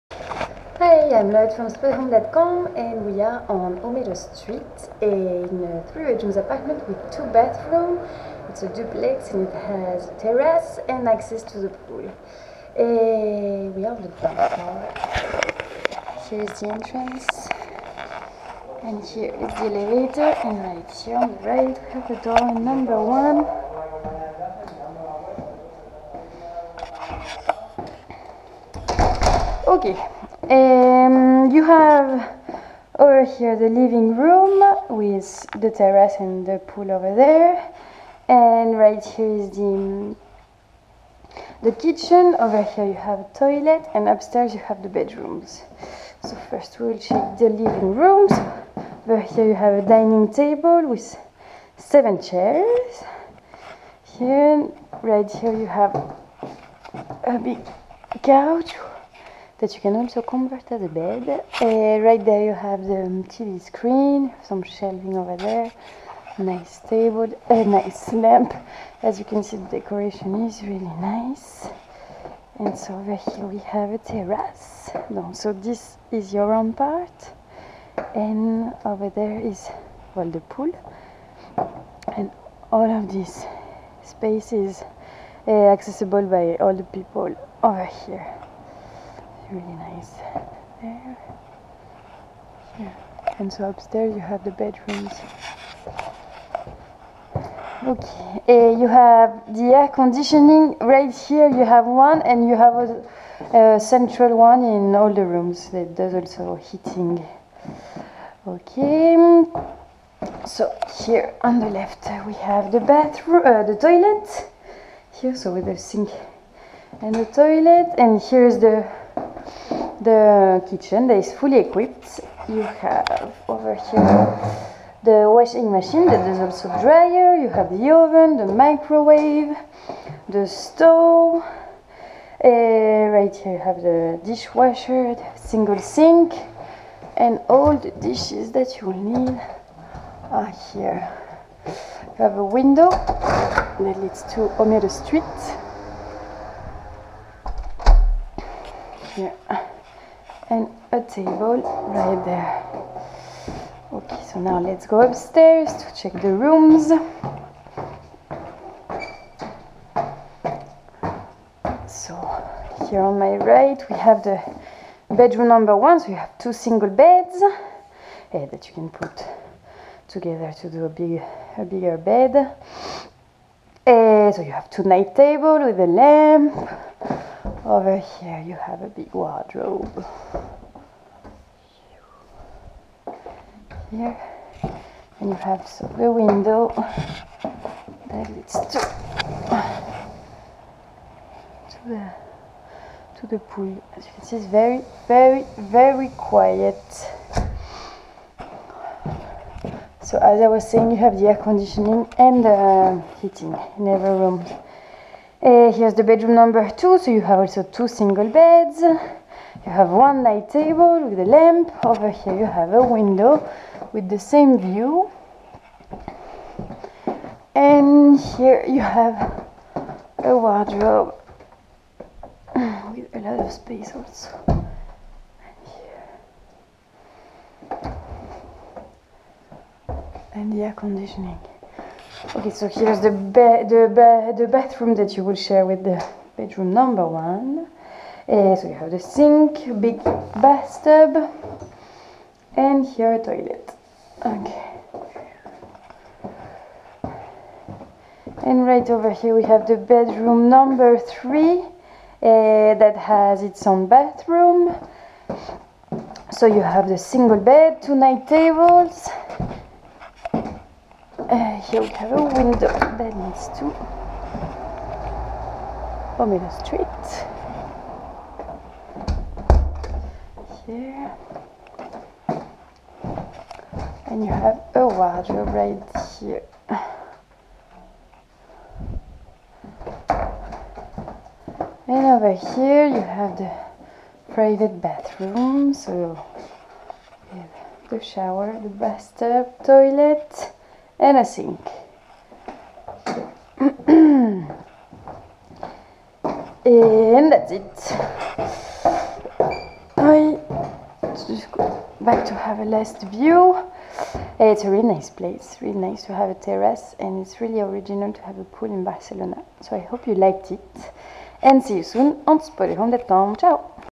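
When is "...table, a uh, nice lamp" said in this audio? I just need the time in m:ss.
1:06.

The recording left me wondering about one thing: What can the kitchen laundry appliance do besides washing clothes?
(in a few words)
dryer.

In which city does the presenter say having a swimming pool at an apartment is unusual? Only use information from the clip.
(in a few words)
Barcelona.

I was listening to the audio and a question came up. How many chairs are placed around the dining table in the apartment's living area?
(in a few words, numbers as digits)
7.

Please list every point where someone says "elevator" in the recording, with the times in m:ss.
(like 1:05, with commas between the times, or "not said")
0:19.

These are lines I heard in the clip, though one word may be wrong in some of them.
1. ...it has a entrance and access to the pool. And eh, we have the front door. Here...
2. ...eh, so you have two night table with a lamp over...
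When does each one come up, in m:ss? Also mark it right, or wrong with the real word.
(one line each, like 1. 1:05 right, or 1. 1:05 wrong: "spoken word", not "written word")
1. 0:09 wrong: "terrace", not "entrance"
2. 2:53 right.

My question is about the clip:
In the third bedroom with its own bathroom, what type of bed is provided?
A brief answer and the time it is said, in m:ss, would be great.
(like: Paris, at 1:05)
single bed, at 4:16.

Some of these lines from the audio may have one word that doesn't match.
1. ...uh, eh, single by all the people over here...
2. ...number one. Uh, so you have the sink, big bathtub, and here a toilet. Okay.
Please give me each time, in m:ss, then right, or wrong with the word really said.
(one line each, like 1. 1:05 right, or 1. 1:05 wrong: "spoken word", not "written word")
1. 1:25 wrong: "accessible", not "single"
2. 3:56 right.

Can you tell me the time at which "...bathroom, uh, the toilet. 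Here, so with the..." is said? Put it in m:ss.
1:52.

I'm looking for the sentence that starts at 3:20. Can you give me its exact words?
So as I was saying, you have the air conditioning and the heating in every room.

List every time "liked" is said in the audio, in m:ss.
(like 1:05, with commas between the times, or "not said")
5:10.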